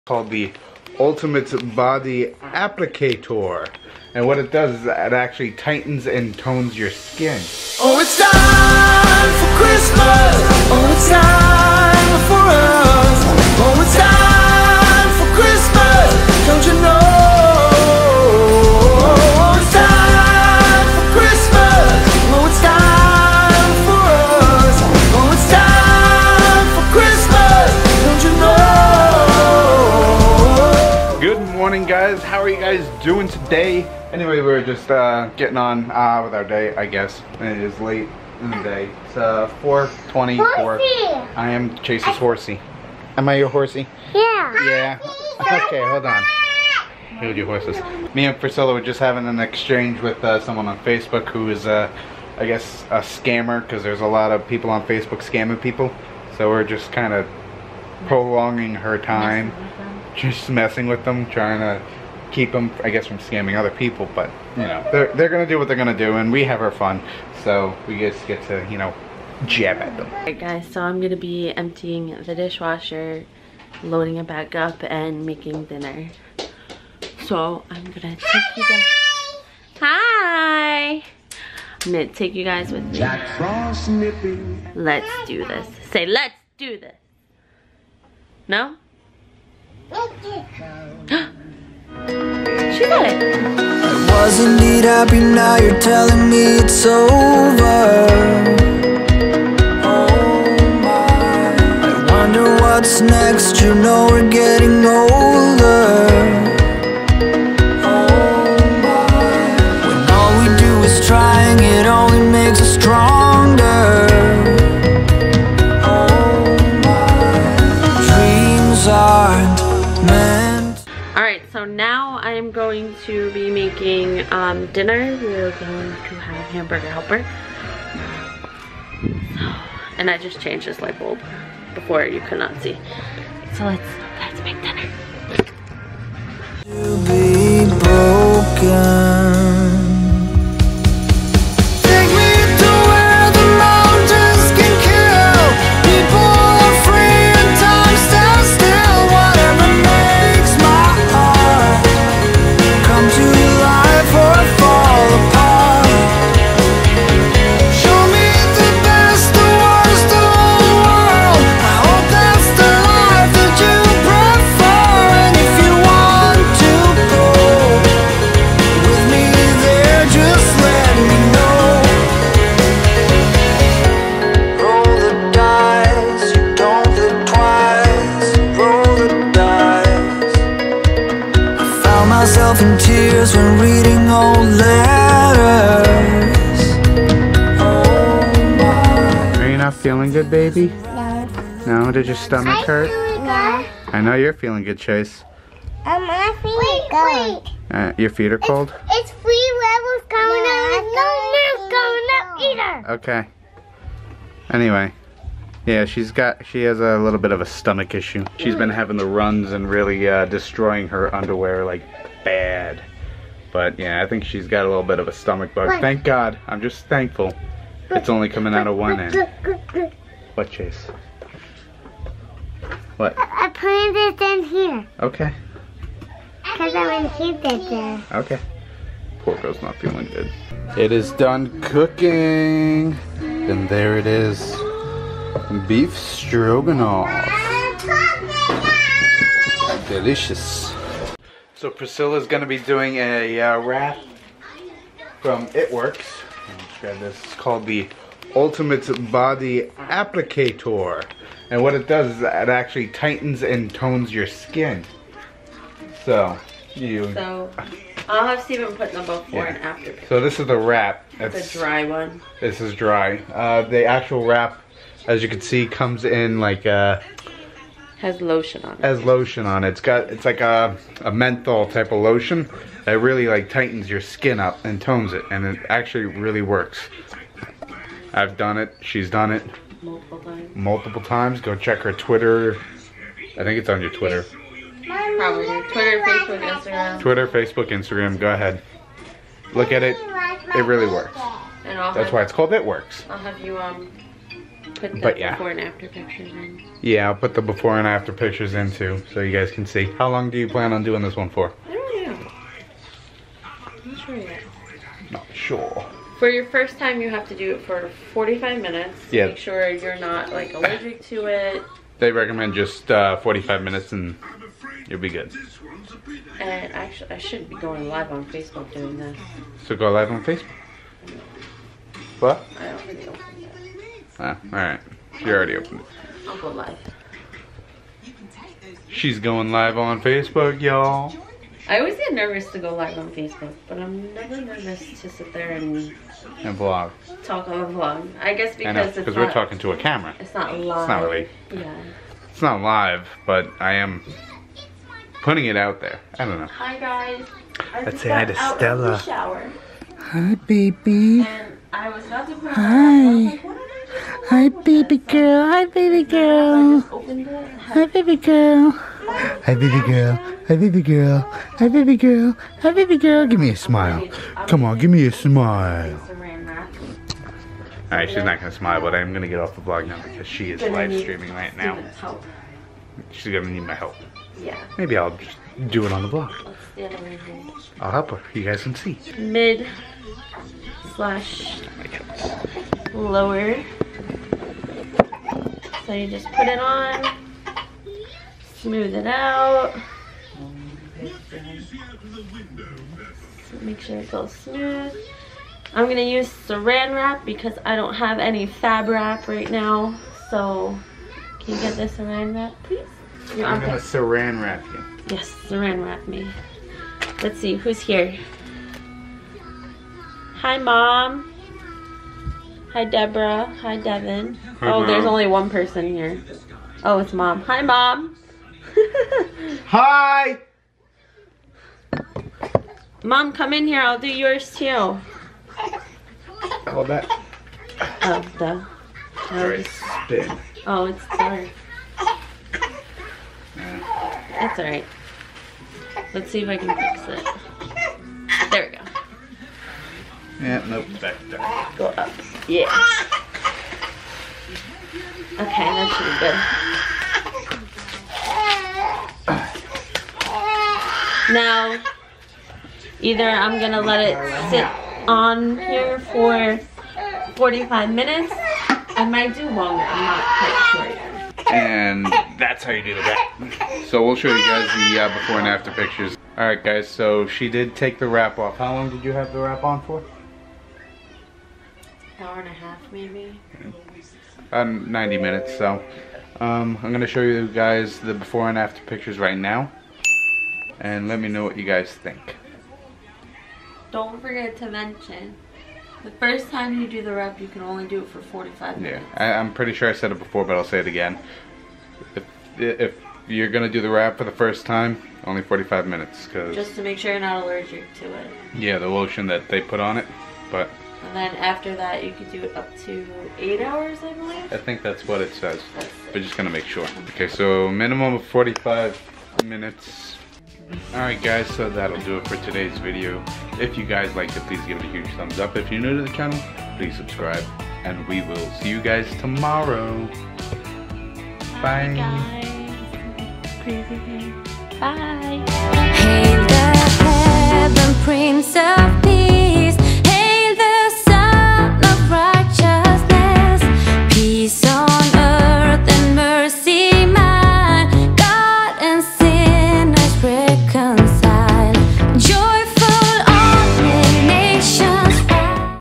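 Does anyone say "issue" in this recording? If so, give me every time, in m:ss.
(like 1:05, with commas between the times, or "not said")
3:27.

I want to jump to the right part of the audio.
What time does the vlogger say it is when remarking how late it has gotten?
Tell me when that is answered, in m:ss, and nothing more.
0:39.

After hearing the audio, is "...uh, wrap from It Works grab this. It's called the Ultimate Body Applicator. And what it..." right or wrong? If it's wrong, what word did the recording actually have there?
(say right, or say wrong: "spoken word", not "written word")
right.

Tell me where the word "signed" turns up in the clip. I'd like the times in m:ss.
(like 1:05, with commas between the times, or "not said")
not said.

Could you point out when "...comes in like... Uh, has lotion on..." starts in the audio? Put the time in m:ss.
4:25.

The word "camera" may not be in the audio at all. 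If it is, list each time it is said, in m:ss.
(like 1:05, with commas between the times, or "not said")
5:39.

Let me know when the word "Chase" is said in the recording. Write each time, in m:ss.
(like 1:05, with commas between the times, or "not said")
0:41, 3:14, 3:40.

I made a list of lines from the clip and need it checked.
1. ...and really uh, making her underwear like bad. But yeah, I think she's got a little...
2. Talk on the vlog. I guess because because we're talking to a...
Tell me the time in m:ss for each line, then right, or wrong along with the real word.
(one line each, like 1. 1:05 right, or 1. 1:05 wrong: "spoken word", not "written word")
1. 3:29 wrong: "destroying", not "making"
2. 5:37 right.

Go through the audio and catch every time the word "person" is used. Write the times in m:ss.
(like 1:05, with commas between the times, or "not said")
6:55.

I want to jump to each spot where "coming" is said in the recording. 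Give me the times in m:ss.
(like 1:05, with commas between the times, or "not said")
3:20, 3:38.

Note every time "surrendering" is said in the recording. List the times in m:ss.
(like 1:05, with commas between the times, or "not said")
not said.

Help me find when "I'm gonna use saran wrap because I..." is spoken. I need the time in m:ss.
6:35.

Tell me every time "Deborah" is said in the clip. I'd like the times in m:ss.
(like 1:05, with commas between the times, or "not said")
6:52.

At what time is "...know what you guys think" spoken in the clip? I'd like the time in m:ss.
8:01.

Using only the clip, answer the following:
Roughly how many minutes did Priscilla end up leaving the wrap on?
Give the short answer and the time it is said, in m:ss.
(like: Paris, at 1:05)
90, at 7:54.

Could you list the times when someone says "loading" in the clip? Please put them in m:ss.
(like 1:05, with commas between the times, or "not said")
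1:13.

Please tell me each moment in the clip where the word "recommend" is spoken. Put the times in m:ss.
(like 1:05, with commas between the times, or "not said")
5:12.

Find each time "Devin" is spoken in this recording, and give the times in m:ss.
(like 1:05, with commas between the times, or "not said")
6:53.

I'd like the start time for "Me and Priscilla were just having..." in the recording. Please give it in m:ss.
0:48.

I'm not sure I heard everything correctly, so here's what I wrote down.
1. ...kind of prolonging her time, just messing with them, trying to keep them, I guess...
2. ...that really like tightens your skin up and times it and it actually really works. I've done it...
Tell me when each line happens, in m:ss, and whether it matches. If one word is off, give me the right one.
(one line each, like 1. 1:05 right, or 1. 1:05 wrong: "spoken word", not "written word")
1. 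0:56 right
2. 4:32 wrong: "tones", not "times".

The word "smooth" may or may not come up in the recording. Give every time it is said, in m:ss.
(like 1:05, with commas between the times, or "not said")
6:28, 6:34.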